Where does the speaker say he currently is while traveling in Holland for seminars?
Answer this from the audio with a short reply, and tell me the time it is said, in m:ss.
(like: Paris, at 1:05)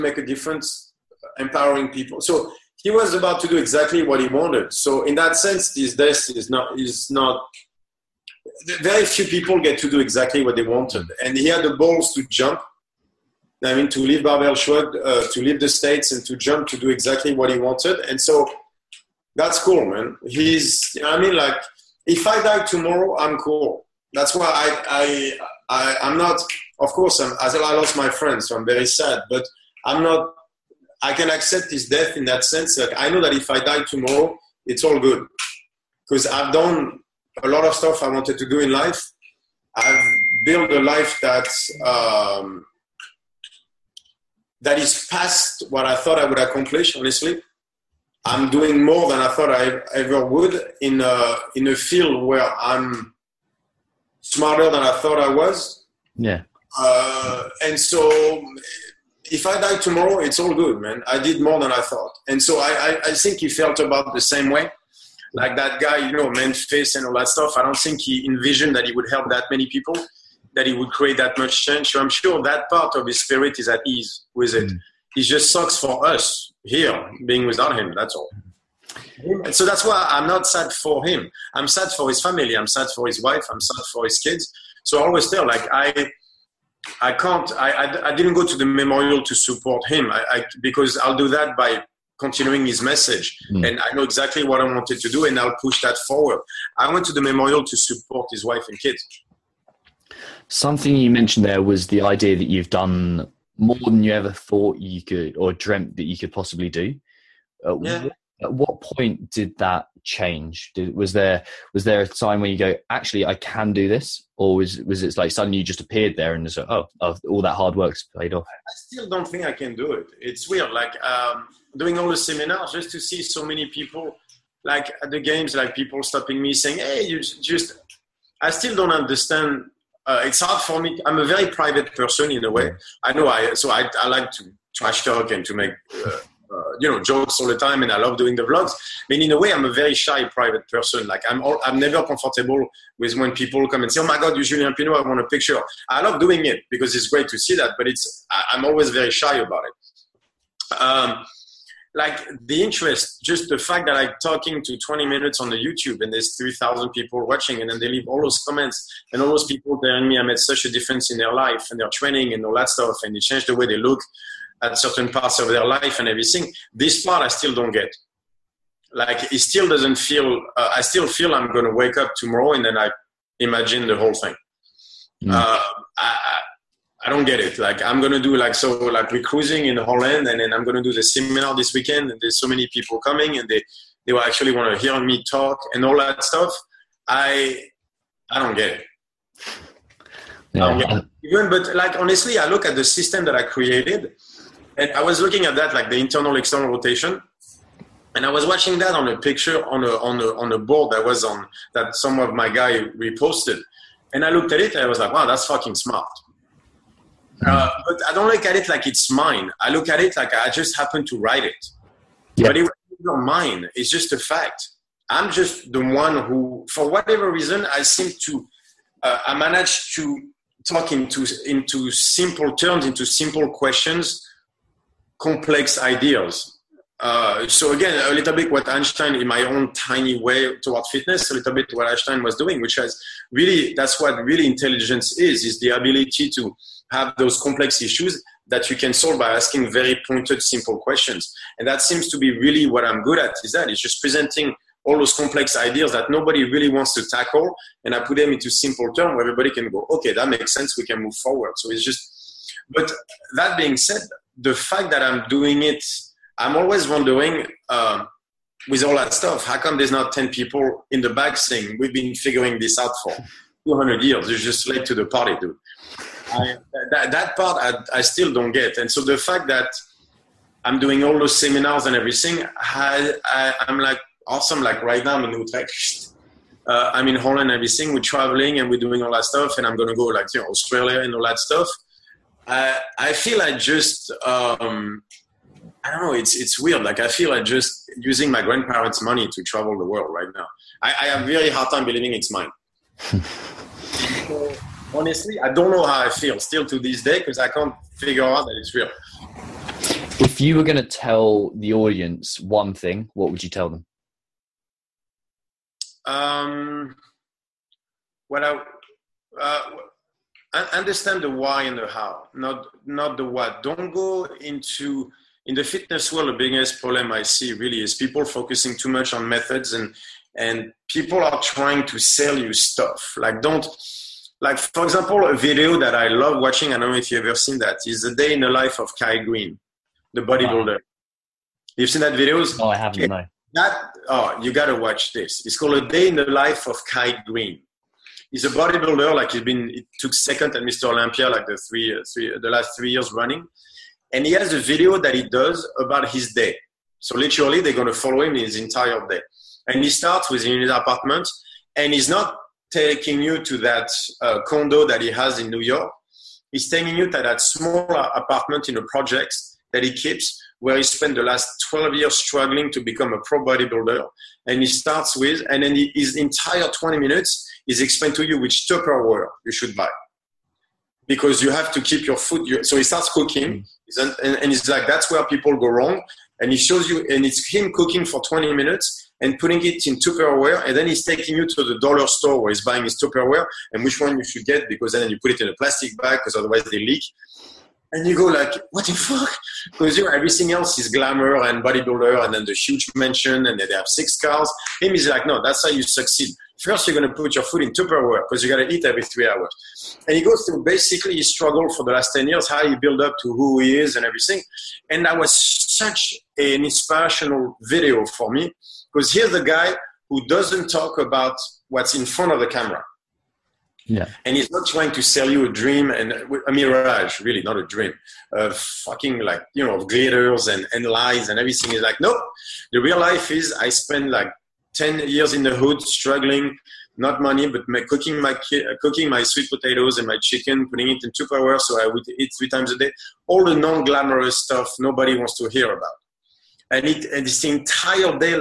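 Utrecht, at 4:35.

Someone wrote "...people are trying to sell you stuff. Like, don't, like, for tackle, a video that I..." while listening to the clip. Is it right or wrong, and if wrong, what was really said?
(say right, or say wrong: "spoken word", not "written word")
wrong: "example", not "tackle".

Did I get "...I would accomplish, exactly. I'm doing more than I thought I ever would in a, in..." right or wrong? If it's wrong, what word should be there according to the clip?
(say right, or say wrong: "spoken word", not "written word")
wrong: "honestly", not "exactly".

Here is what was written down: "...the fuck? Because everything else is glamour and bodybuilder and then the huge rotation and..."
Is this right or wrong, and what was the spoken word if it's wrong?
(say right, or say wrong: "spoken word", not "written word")
wrong: "mansion", not "rotation".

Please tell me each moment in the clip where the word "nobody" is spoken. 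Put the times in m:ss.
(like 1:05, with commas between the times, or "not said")
4:06, 7:14.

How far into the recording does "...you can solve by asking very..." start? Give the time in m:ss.
3:58.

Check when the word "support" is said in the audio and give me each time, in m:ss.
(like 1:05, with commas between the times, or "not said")
1:29, 1:37.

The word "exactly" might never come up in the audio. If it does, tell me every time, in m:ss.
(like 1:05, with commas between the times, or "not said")
0:03, 0:09, 0:16, 1:34.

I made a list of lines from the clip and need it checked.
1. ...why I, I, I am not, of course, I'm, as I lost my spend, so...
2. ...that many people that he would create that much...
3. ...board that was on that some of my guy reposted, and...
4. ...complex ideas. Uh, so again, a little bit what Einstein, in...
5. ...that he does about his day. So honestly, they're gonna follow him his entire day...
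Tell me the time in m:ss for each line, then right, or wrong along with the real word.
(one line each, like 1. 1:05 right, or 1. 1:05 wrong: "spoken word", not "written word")
1. 0:24 wrong: "friend", not "spend"
2. 1:09 right
3. 3:20 right
4. 3:45 right
5. 5:44 wrong: "literally", not "honestly".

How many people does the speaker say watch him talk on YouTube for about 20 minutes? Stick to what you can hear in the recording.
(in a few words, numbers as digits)
3,000.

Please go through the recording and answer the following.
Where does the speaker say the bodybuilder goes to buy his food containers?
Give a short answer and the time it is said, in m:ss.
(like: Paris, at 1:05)
The dollar store, at 6:21.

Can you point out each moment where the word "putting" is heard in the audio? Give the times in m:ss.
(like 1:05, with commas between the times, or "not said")
6:19, 7:10.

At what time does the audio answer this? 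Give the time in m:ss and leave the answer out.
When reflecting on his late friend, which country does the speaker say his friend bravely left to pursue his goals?
0:15.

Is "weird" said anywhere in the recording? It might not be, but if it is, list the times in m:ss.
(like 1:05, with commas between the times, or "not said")
2:00, 4:46.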